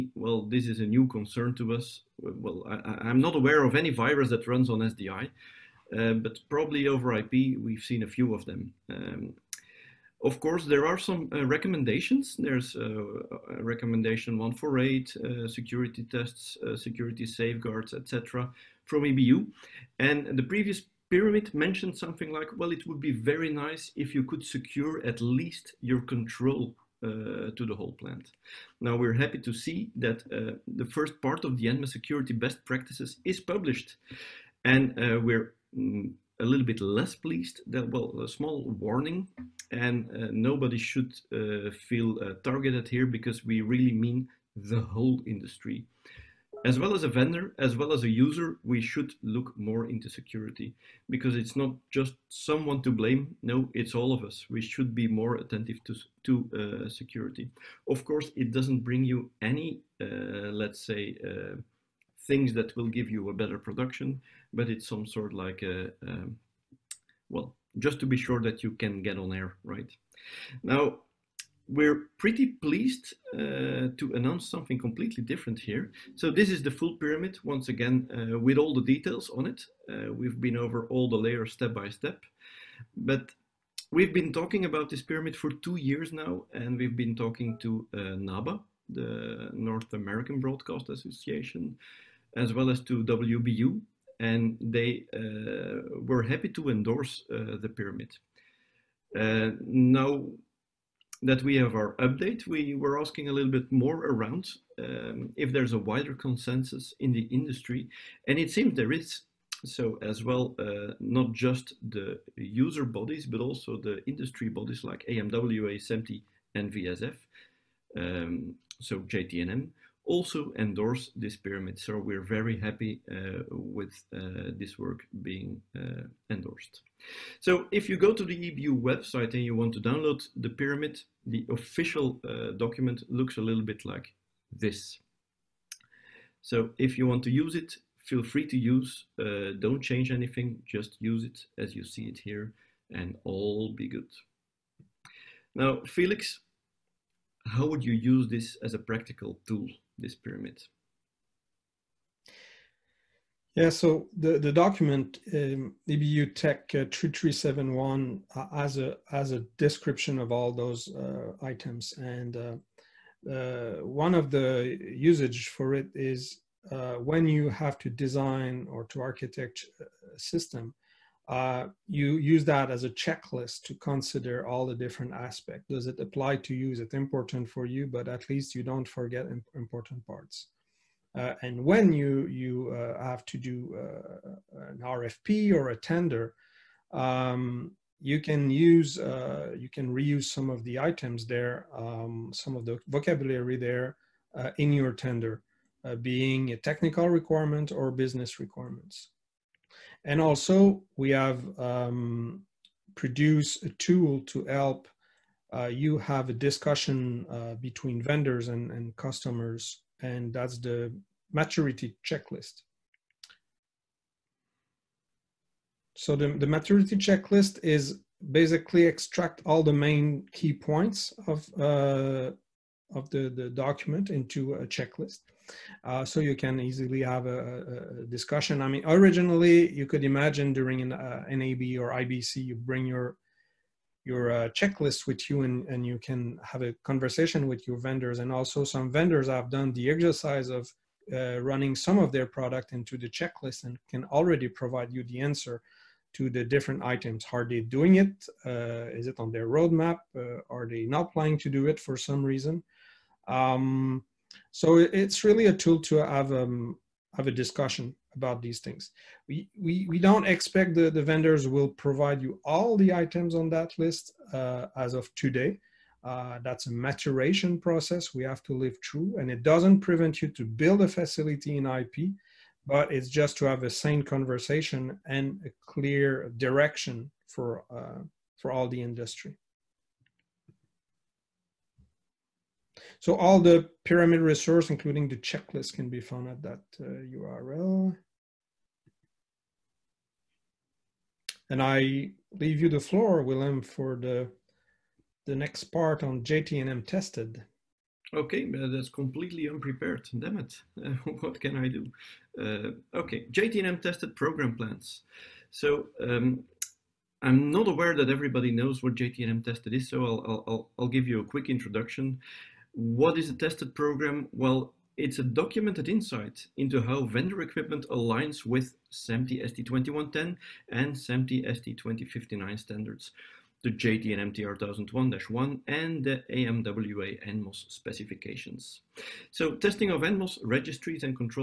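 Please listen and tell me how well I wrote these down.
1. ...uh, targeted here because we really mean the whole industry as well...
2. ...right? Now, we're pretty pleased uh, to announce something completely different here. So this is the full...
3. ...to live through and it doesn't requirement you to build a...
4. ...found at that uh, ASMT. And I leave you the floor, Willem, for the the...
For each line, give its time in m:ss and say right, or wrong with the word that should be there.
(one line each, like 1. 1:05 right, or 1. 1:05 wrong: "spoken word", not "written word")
1. 0:42 right
2. 1:09 right
3. 4:28 wrong: "prevent", not "requirement"
4. 4:45 wrong: "URL", not "ASMT".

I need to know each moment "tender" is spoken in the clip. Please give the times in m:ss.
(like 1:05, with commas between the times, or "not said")
3:05, 3:14.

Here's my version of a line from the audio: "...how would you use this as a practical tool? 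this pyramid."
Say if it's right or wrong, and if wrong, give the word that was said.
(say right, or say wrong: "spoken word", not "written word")
right.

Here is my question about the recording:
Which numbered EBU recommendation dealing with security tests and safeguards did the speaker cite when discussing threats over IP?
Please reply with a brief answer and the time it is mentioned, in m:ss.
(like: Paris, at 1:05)
148, at 0:13.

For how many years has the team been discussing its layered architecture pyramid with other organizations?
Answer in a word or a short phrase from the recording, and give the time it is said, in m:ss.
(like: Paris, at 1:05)
2, at 1:25.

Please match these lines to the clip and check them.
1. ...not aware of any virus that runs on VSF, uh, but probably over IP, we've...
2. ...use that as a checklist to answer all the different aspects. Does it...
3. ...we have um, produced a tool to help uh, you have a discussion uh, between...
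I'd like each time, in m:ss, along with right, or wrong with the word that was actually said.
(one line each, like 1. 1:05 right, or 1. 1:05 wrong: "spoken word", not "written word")
1. 0:03 wrong: "SDI", not "VSF"
2. 2:52 wrong: "consider", not "answer"
3. 3:20 right.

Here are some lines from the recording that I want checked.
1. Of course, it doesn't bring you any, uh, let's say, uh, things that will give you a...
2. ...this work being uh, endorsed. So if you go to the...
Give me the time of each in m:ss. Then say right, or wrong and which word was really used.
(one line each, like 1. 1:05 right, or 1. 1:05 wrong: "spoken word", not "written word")
1. 0:57 right
2. 2:04 right.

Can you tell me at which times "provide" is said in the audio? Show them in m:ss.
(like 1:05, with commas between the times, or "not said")
4:04, 4:21.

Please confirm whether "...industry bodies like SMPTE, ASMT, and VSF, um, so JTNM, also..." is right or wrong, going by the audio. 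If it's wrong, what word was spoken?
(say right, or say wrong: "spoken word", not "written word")
wrong: "AMWA", not "SMPTE".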